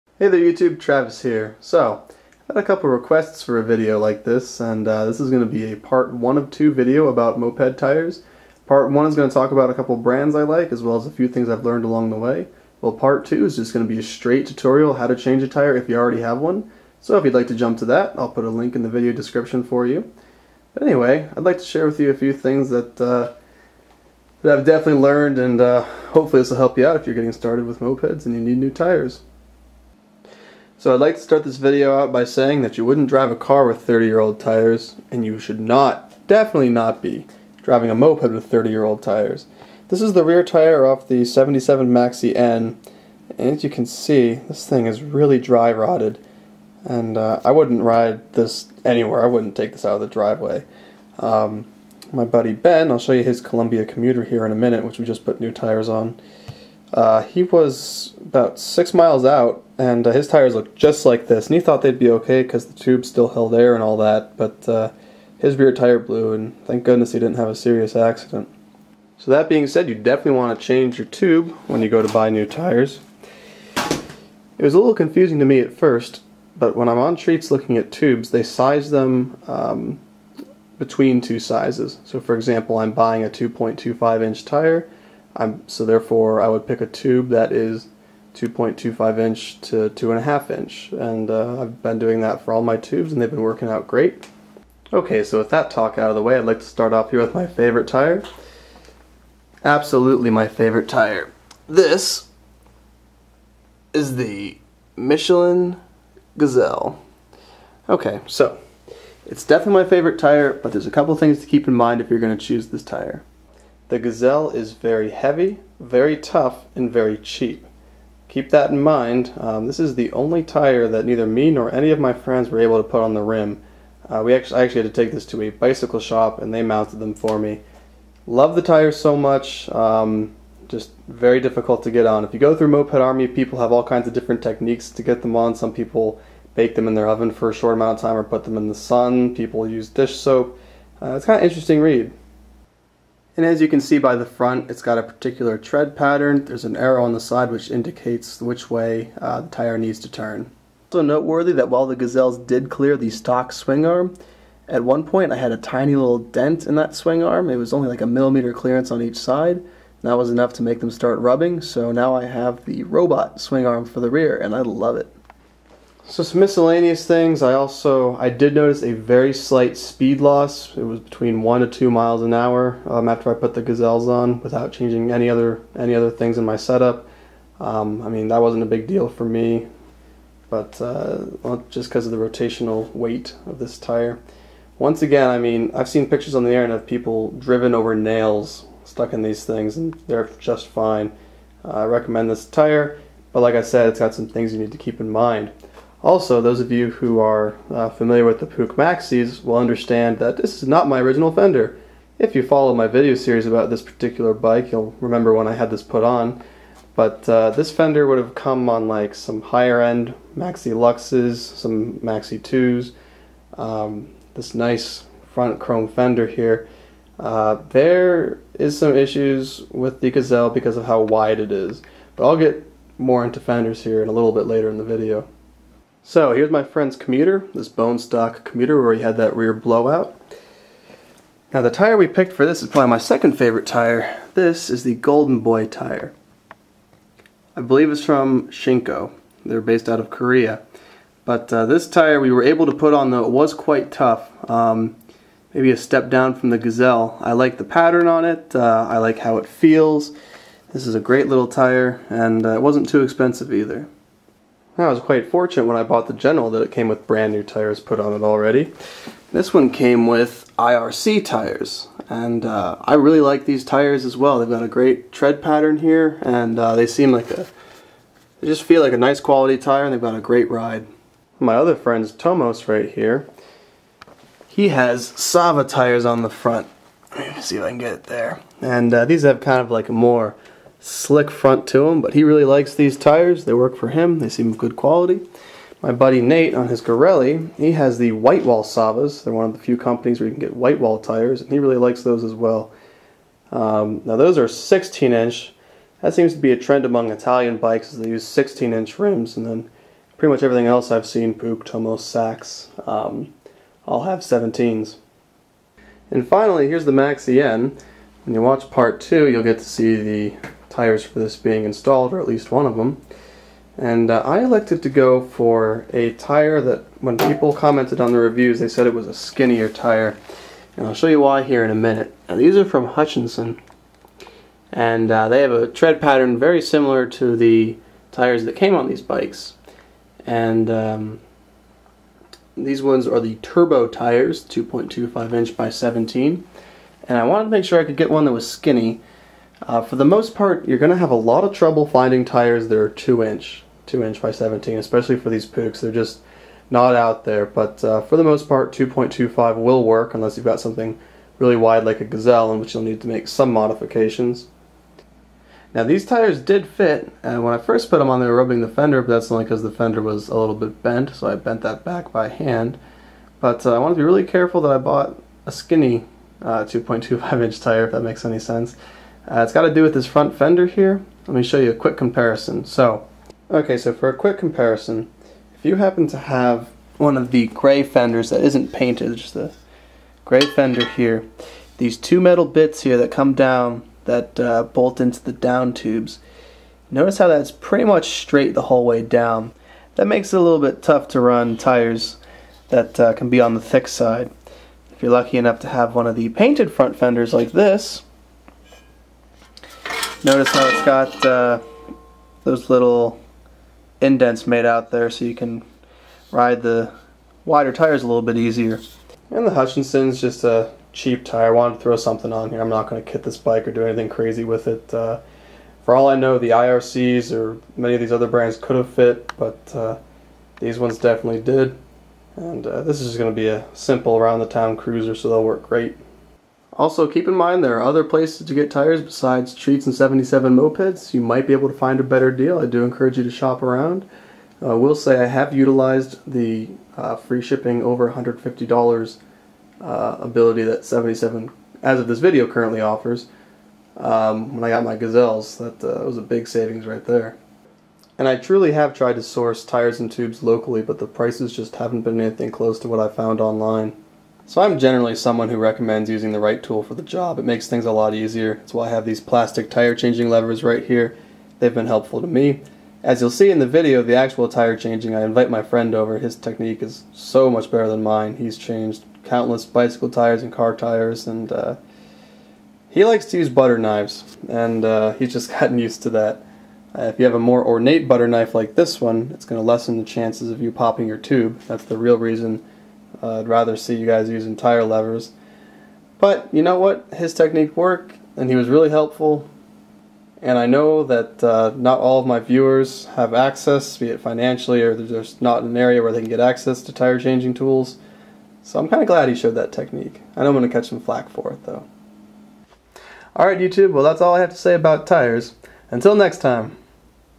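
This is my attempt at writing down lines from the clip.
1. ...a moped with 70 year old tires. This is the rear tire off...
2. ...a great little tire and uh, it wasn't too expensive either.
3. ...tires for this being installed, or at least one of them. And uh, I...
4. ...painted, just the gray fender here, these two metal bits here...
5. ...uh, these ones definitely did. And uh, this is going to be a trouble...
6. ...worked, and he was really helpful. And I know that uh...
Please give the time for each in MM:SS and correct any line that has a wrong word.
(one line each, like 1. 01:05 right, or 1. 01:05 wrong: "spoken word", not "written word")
1. 00:37 wrong: "30", not "70"
2. 04:10 right
3. 05:10 right
4. 06:18 right
5. 06:59 wrong: "simple", not "trouble"
6. 08:07 right.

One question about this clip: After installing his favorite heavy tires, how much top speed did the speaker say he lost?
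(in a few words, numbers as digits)
1 to 2 mph.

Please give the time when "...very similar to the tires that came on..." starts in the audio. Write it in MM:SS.
05:26.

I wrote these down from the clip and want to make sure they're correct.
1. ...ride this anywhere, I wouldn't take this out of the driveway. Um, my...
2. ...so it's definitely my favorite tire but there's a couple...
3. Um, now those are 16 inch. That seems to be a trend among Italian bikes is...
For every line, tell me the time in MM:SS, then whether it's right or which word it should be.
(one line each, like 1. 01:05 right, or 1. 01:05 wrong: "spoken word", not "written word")
1. 00:47 right
2. 01:48 right
3. 04:53 right.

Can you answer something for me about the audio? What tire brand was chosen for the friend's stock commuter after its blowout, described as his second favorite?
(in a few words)
Golden Boy.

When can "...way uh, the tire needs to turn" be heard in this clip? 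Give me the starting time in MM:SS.
02:28.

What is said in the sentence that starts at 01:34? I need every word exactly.
Okay so with that talk out of the way I'd like to start off here with my favorite tire.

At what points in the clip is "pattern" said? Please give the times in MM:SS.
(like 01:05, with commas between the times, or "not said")
02:25, 04:07, 04:25, 05:25.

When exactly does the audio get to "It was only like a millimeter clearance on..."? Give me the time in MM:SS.
02:37.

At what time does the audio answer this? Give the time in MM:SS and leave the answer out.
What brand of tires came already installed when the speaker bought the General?
04:20.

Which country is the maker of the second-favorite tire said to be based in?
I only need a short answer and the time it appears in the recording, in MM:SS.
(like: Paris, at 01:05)
Korea, at 04:00.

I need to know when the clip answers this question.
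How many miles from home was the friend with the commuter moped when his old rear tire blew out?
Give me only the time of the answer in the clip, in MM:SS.
00:58.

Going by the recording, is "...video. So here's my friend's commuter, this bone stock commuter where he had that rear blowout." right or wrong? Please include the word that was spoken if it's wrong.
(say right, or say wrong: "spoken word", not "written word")
right.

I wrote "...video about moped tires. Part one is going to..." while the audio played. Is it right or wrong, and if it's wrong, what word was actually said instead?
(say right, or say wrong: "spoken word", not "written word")
right.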